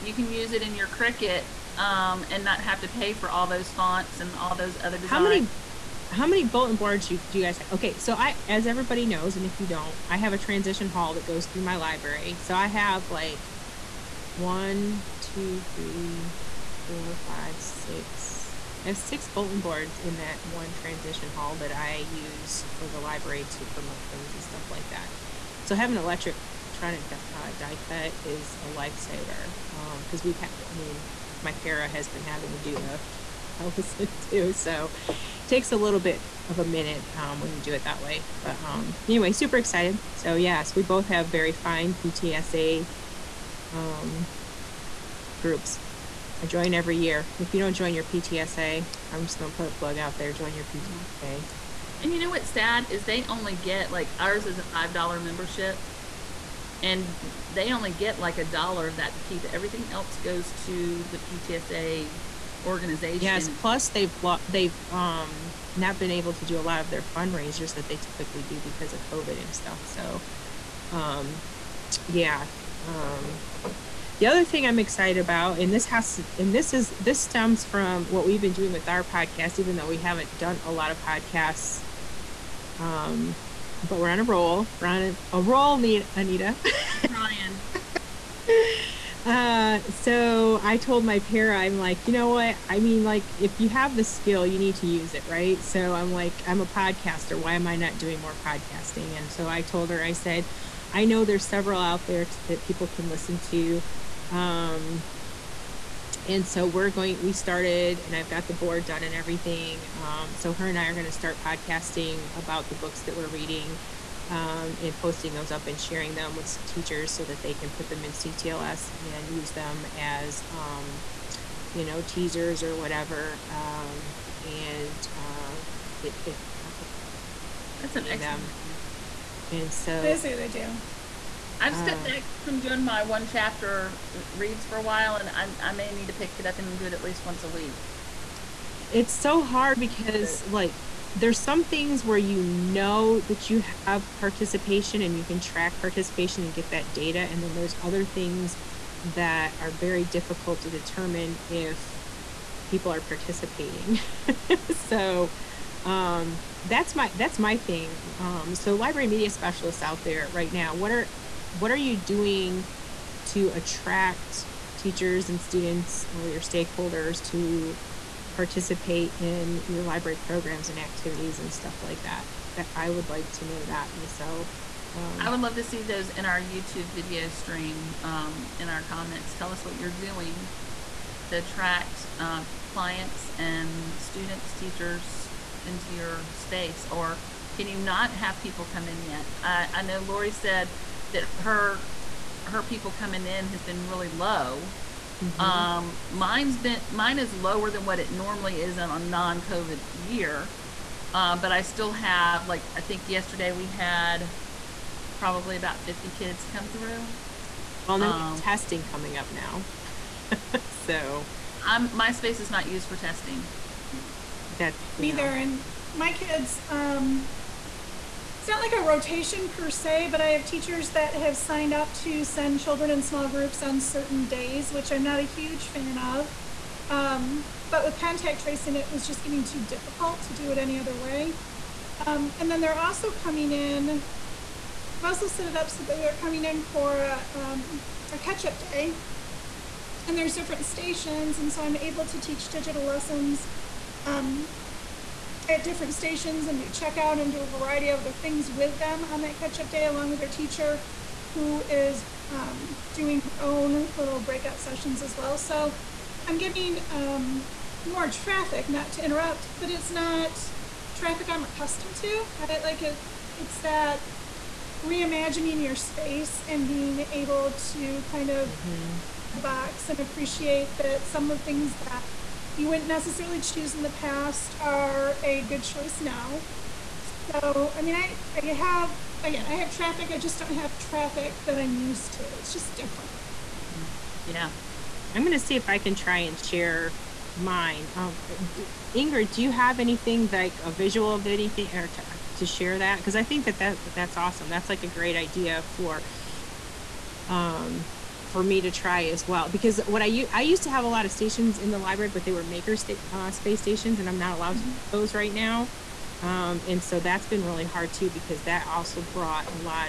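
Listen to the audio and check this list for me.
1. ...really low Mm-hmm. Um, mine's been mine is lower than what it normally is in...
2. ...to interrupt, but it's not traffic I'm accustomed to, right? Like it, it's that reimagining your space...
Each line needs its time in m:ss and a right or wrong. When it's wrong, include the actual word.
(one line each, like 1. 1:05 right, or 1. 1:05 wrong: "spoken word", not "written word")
1. 3:13 right
2. 4:18 right.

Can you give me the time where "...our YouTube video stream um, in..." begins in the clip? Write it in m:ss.
2:56.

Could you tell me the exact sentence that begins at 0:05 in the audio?
How many how many bulletin boards you, do you guys have?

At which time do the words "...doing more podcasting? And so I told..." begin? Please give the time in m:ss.
1:37.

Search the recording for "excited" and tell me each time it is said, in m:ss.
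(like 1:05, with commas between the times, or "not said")
0:39, 1:14.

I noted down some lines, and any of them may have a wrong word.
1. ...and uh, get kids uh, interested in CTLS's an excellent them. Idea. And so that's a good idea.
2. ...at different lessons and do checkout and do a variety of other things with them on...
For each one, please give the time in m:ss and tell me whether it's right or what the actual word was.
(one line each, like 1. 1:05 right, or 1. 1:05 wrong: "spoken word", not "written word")
1. 2:04 wrong: "That", not "CTLS"
2. 4:05 wrong: "stations", not "lessons".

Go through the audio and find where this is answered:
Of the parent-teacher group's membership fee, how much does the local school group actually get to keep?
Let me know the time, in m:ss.
0:58.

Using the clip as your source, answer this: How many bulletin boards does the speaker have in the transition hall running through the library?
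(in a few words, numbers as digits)
6.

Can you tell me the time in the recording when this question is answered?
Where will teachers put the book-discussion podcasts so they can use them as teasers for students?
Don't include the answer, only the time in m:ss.
1:58.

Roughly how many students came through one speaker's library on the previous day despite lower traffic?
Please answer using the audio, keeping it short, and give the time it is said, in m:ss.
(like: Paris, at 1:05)
50, at 3:25.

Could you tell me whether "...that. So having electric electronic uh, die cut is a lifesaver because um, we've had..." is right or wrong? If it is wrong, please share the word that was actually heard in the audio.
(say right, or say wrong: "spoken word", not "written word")
right.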